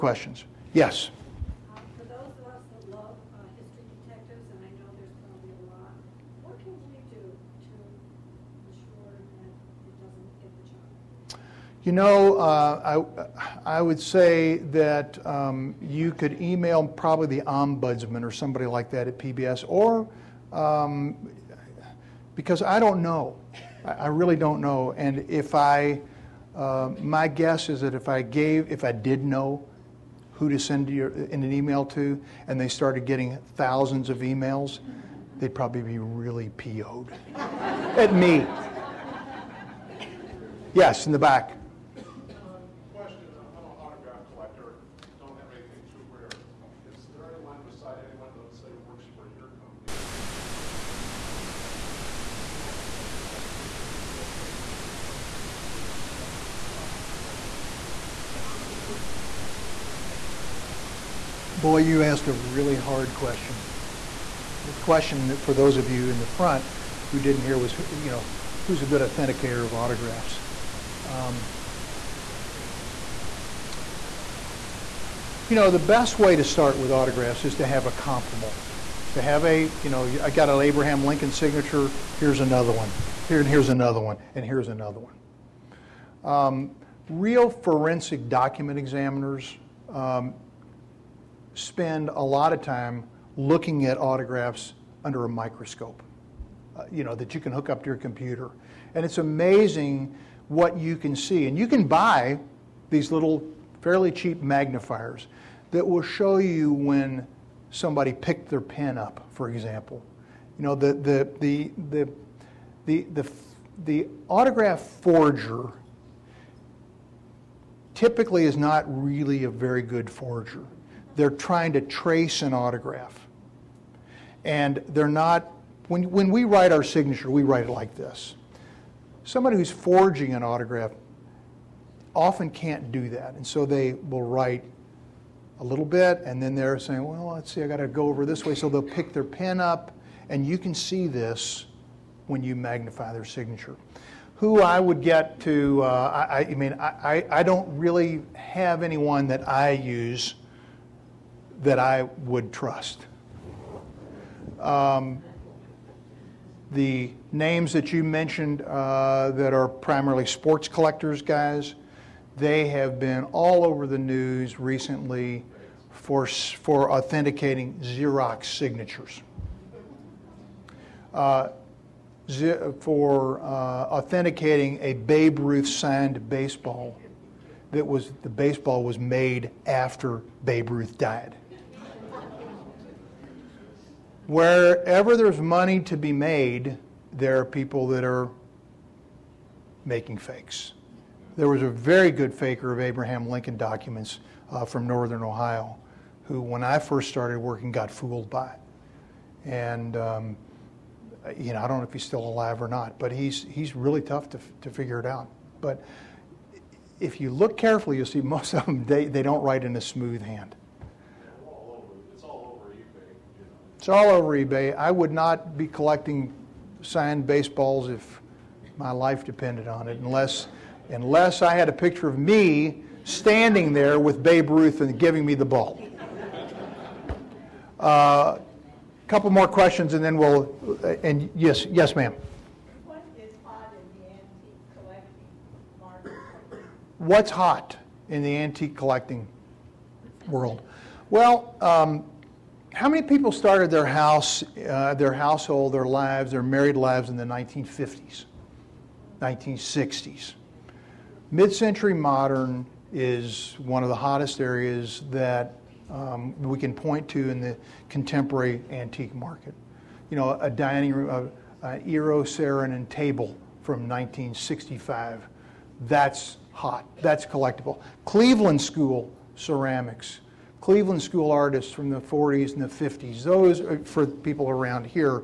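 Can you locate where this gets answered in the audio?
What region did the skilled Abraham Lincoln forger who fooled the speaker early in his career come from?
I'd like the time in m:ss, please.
3:14.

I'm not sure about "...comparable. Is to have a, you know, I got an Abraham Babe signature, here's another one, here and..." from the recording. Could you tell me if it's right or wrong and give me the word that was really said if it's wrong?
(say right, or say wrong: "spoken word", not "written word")
wrong: "Lincoln", not "Babe".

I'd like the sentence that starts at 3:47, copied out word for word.
A uh, couple more questions, and then we'll.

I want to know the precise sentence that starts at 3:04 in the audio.
Wherever there's money to be made, there are people that are making fakes.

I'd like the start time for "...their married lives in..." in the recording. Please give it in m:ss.
4:06.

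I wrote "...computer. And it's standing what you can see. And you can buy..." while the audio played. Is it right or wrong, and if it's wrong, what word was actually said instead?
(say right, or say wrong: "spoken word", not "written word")
wrong: "amazing", not "standing".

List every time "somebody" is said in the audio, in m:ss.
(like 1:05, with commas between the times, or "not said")
0:18, 1:47, 2:09.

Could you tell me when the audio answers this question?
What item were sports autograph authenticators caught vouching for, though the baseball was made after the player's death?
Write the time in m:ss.
2:54.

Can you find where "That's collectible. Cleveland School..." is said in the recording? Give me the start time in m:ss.
4:27.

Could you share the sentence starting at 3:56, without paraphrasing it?
What's hot in the antique collecting world?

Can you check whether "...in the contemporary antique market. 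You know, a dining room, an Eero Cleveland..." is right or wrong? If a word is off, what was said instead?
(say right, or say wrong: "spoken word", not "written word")
wrong: "Saarinen", not "Cleveland".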